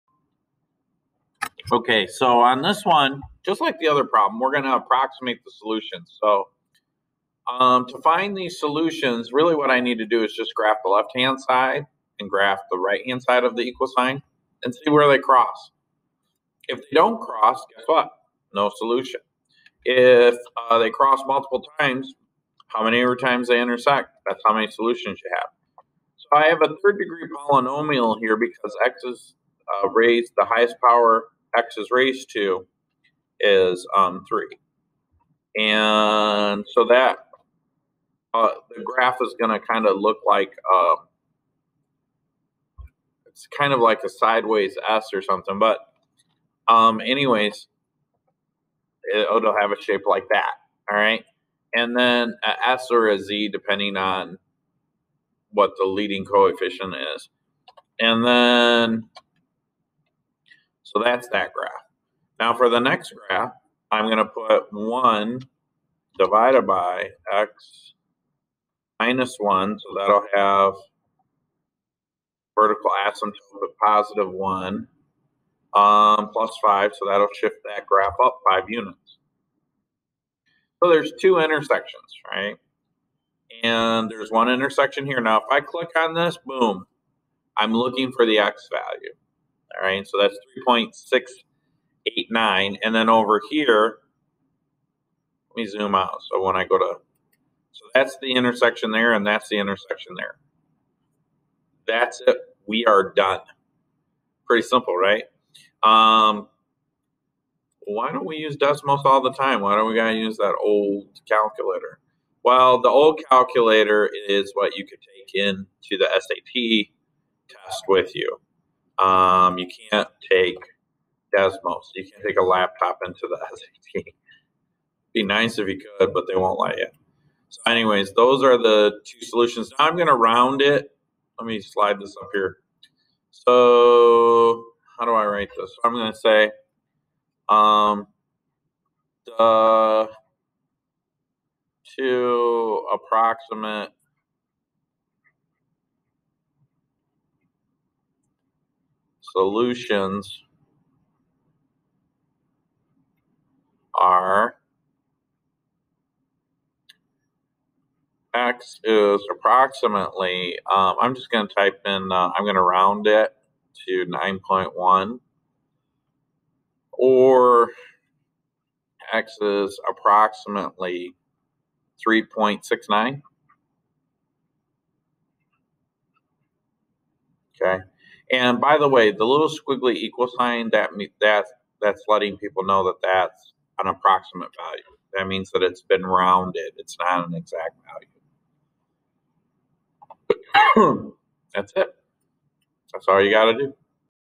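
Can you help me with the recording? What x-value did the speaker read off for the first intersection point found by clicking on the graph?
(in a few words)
3.689.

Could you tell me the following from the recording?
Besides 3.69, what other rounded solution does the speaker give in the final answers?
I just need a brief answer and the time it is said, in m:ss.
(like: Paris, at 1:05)
9.1, at 2:44.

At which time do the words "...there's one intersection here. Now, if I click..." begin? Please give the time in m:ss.
1:24.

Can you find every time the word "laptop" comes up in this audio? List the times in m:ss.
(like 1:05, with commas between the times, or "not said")
2:02.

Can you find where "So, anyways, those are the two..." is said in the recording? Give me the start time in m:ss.
2:07.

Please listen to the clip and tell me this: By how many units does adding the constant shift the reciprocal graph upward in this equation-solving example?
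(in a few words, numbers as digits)
5.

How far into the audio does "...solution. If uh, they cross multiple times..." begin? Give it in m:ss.
0:18.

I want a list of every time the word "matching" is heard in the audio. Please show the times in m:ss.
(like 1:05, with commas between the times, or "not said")
not said.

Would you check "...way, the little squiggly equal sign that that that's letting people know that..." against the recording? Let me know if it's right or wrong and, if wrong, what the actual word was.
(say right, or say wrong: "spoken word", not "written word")
right.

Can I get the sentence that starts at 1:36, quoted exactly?
So when I go to, so that's the intersection there and that's the intersection there.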